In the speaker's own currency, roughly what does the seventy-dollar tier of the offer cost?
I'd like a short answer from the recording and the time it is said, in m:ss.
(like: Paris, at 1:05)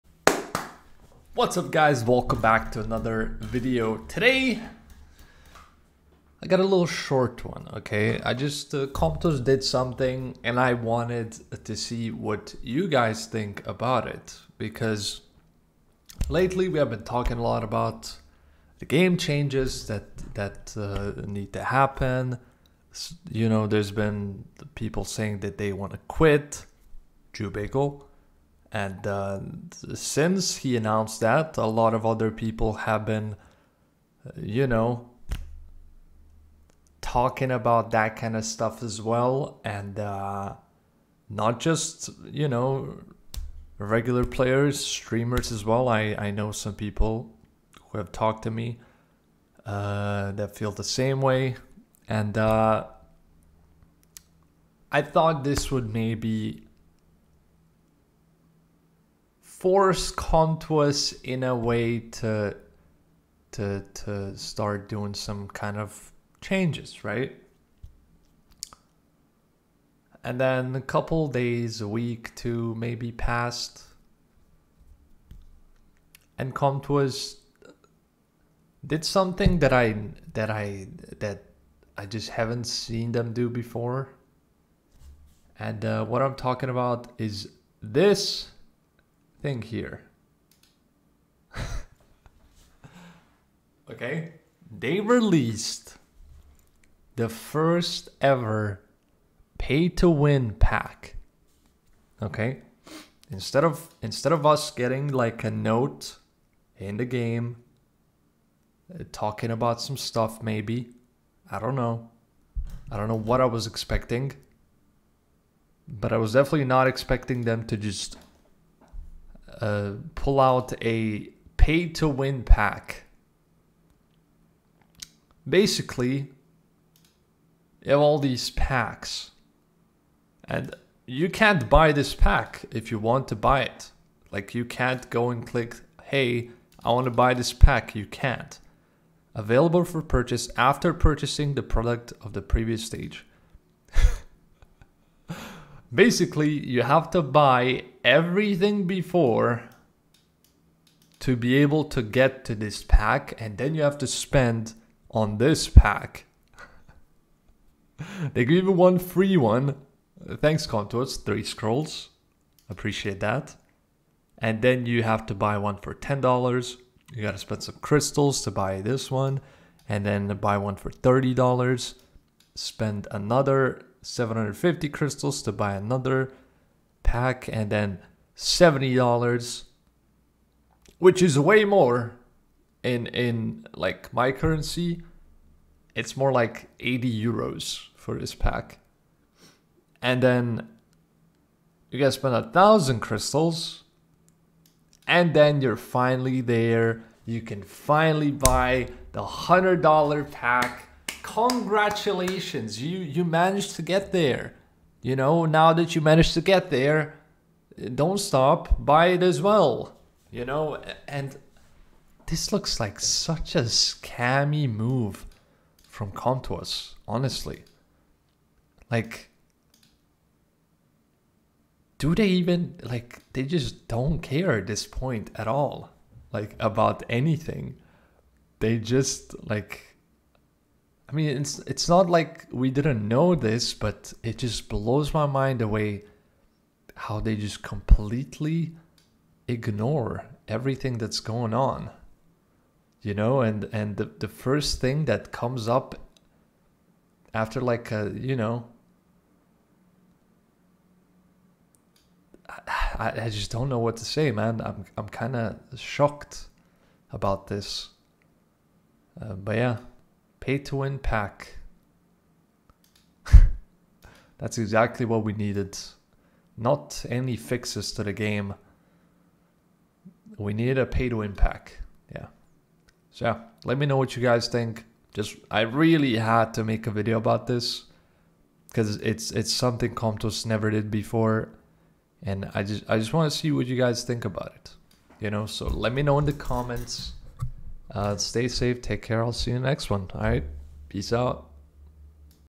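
80 euros, at 3:06.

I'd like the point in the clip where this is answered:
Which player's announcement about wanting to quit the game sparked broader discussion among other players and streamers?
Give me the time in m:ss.
0:27.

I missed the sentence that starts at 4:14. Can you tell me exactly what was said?
I'm I'm kind of shocked about this.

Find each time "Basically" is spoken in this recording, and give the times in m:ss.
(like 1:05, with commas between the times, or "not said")
2:05, 2:25.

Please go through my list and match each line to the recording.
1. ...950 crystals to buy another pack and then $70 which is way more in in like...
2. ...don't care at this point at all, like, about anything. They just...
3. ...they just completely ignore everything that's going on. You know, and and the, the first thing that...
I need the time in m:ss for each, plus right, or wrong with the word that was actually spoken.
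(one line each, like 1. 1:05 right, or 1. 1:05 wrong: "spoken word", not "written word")
1. 2:54 wrong: "750", not "950"
2. 3:43 right
3. 3:57 right.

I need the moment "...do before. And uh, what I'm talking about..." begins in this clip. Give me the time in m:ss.
1:23.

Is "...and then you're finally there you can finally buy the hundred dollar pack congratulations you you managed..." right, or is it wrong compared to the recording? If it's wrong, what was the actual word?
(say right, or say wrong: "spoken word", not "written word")
right.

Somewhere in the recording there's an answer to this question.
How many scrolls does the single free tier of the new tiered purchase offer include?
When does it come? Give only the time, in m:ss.
2:41.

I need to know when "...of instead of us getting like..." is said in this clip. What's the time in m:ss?
1:43.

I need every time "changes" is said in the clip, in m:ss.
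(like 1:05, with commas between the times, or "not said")
0:19, 1:06.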